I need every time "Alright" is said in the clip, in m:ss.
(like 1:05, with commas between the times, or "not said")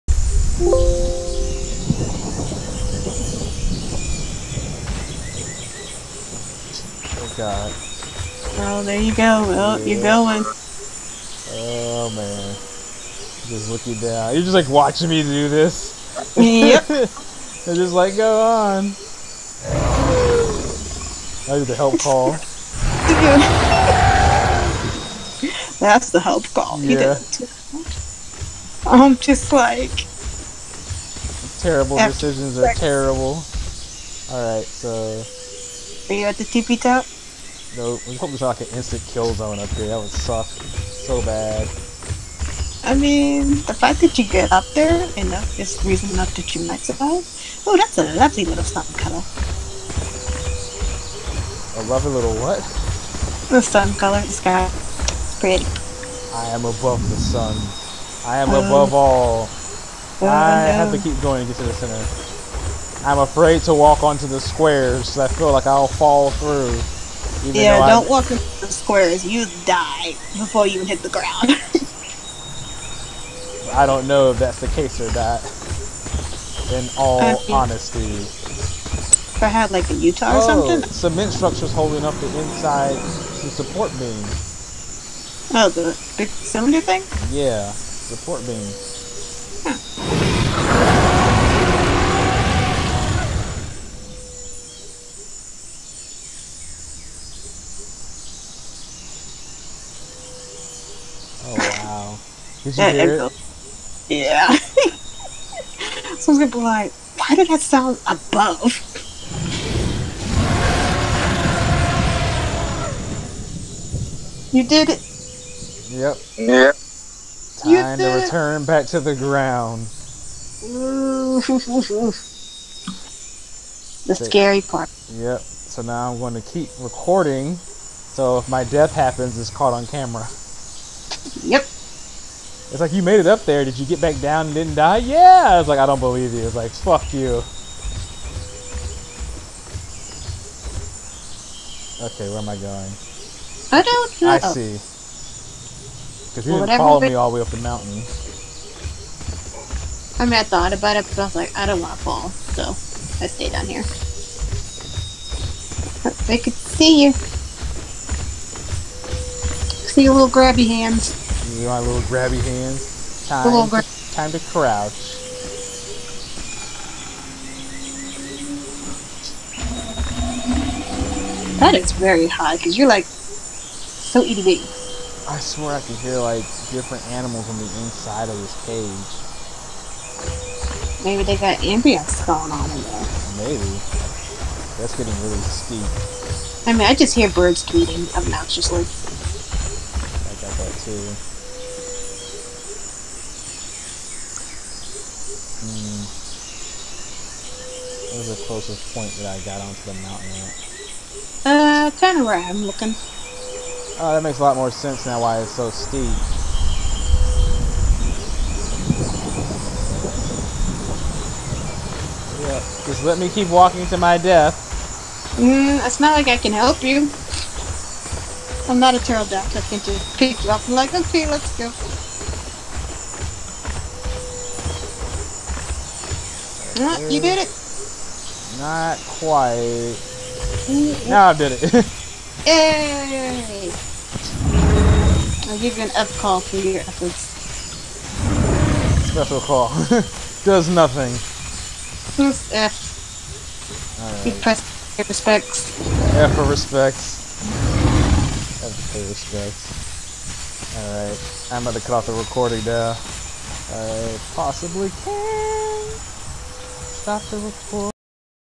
0:34, 4:10.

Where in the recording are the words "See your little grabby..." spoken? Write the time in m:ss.
2:37.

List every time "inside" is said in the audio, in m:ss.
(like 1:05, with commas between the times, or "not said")
1:22, 2:57.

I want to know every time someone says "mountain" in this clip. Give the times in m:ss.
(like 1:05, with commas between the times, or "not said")
2:27, 3:20.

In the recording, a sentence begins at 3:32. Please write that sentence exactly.
Yeah, just let me keep walking to my death.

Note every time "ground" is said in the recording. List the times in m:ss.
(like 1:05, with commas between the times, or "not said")
1:11, 1:59.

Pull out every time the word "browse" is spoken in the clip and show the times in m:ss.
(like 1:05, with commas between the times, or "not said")
not said.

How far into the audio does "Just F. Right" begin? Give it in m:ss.
4:02.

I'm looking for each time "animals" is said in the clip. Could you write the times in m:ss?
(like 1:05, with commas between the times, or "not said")
2:57.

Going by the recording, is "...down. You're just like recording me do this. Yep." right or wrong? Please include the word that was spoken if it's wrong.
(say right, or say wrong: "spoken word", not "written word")
wrong: "watching", not "recording".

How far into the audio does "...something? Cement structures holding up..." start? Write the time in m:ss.
1:20.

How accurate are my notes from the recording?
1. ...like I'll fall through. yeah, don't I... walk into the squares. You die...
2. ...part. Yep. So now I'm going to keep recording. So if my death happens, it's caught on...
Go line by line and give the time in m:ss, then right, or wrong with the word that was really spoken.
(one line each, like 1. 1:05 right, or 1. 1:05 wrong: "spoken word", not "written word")
1. 1:05 right
2. 2:04 right.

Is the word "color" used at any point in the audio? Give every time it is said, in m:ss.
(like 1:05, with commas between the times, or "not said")
0:48, 0:53.